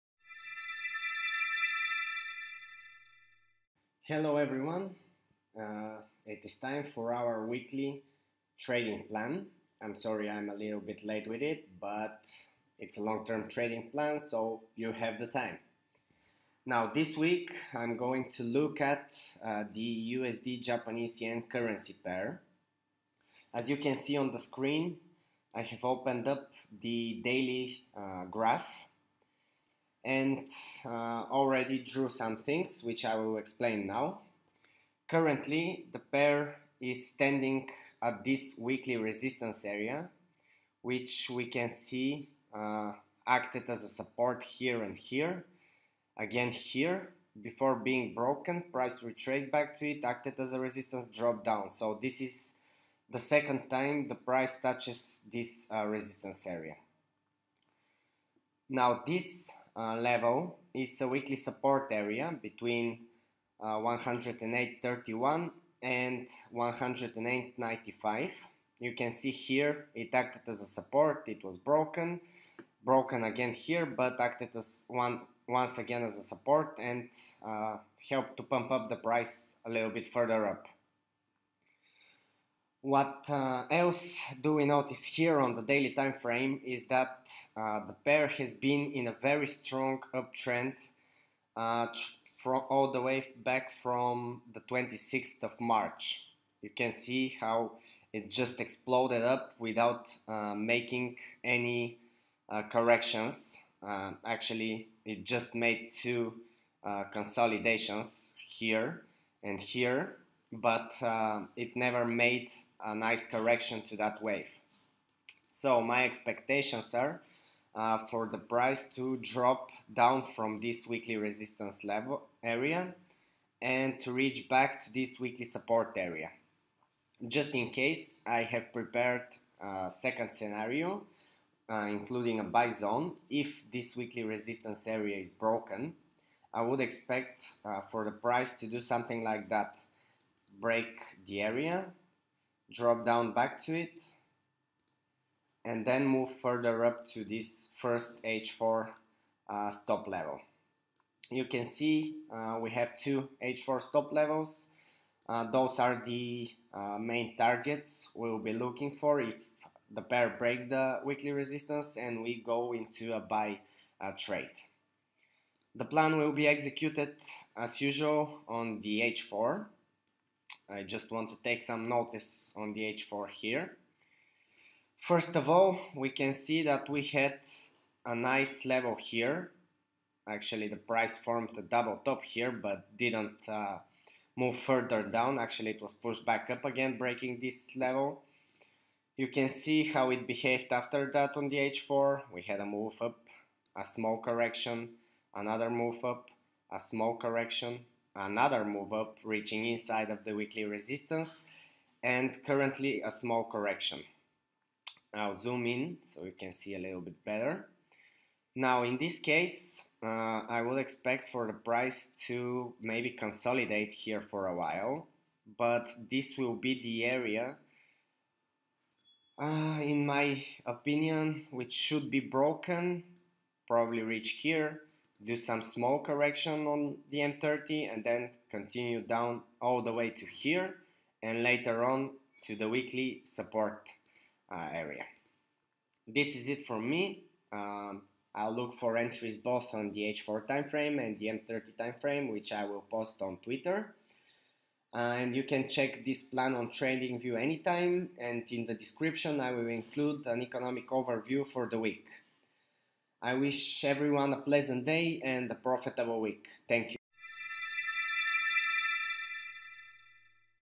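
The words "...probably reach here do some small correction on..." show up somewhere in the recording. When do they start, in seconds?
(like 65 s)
223 s.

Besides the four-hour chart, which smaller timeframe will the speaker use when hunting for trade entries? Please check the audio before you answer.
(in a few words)
M30.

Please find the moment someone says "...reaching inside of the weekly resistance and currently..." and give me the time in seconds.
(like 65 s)
199 s.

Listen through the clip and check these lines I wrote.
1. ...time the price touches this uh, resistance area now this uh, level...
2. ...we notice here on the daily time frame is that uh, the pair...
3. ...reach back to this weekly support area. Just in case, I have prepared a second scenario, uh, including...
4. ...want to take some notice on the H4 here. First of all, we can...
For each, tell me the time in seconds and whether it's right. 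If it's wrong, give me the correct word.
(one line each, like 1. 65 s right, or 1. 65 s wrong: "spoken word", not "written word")
1. 53 s right
2. 84 s right
3. 124 s right
4. 171 s right.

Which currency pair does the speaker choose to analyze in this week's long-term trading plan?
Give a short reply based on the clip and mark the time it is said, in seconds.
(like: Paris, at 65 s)
USD Japanese Yen, at 20 s.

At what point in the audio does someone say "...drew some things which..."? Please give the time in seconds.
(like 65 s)
31 s.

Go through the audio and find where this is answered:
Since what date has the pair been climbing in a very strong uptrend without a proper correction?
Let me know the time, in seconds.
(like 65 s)
94 s.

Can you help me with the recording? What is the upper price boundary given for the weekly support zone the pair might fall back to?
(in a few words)
108.95.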